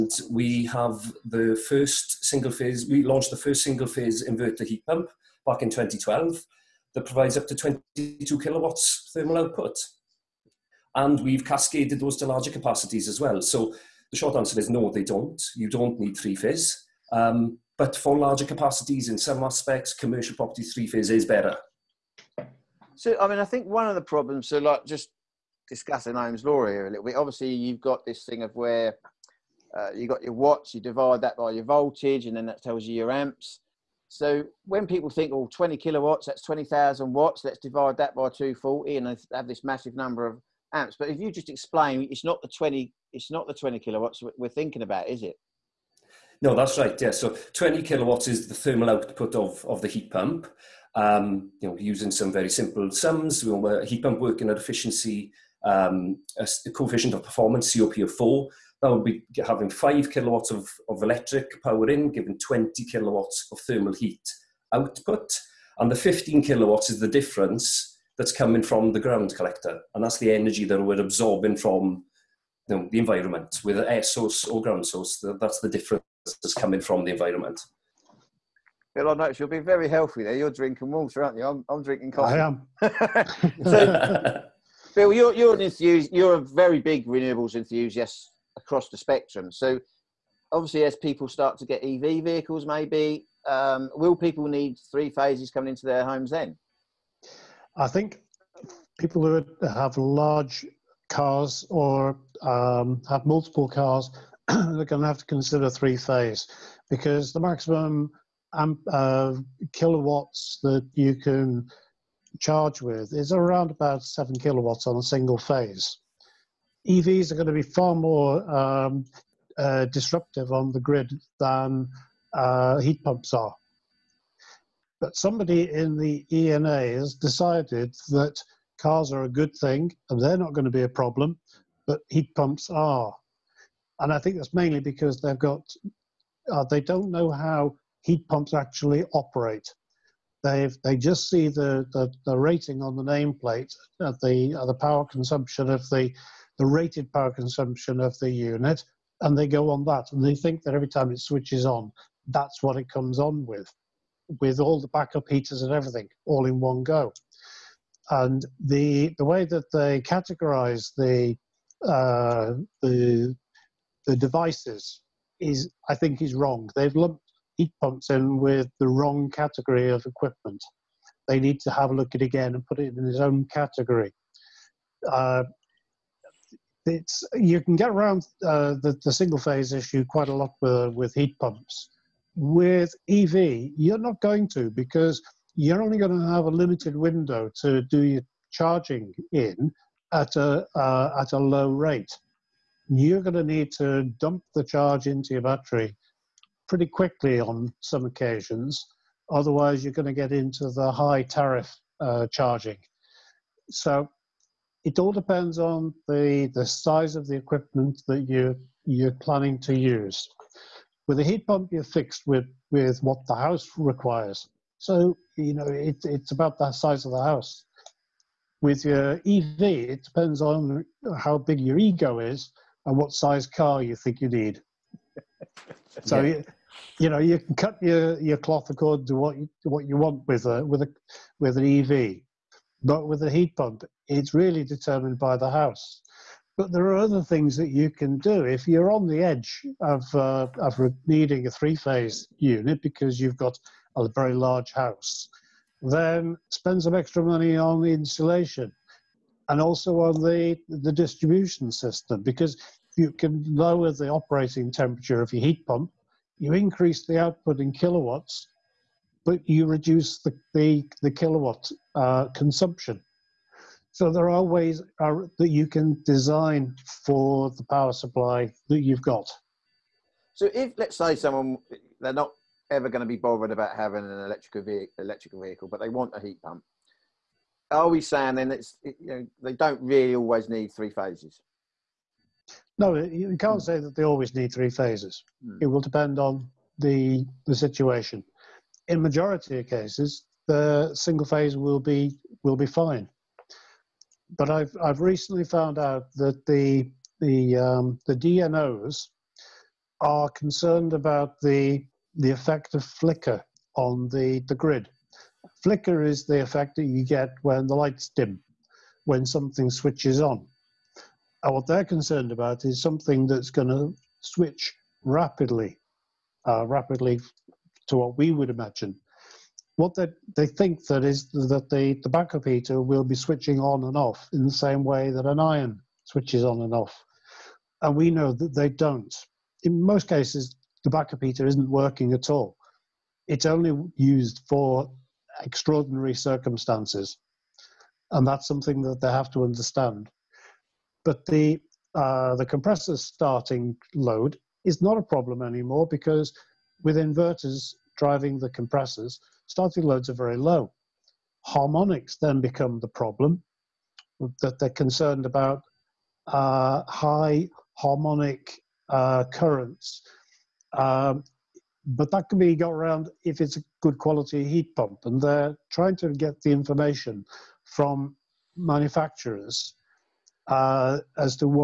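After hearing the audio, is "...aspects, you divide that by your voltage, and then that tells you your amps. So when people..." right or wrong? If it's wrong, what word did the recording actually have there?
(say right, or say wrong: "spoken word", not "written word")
wrong: "watts", not "aspects".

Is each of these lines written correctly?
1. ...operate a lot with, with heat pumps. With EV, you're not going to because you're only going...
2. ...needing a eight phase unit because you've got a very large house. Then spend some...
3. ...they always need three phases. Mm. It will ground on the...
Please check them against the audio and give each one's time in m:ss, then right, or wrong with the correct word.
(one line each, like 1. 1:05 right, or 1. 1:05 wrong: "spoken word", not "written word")
1. 3:00 wrong: "quite", not "operate"
2. 4:01 wrong: "three", not "eight"
3. 4:43 wrong: "depend", not "ground".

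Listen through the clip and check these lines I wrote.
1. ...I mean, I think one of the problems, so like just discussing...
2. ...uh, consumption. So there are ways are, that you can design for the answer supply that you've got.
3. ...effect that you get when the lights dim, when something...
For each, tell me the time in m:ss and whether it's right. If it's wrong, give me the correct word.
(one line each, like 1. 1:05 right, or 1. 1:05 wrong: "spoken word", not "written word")
1. 0:23 right
2. 4:21 wrong: "power", not "answer"
3. 5:06 right.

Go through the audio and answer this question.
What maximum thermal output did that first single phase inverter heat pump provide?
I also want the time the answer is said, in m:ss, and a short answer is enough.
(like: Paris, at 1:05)
22 kilowatts, at 0:07.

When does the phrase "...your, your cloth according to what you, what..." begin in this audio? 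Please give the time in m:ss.
3:47.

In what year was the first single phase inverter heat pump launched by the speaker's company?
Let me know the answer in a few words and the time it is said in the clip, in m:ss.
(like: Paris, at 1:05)
2012, at 0:05.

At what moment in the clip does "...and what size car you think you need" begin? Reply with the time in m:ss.
3:42.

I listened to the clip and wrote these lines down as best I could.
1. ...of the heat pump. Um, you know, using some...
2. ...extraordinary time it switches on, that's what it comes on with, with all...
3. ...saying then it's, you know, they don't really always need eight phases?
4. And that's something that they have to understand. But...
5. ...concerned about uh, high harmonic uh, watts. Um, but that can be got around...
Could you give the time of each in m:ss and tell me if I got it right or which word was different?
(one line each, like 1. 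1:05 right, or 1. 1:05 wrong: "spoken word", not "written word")
1. 0:49 right
2. 2:30 wrong: "every", not "extraordinary"
3. 4:37 wrong: "three", not "eight"
4. 5:38 right
5. 5:54 wrong: "currents", not "watts".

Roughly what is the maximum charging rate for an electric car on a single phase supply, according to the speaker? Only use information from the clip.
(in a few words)
7 kilowatts.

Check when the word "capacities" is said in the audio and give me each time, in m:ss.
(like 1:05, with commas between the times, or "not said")
0:12, 0:18.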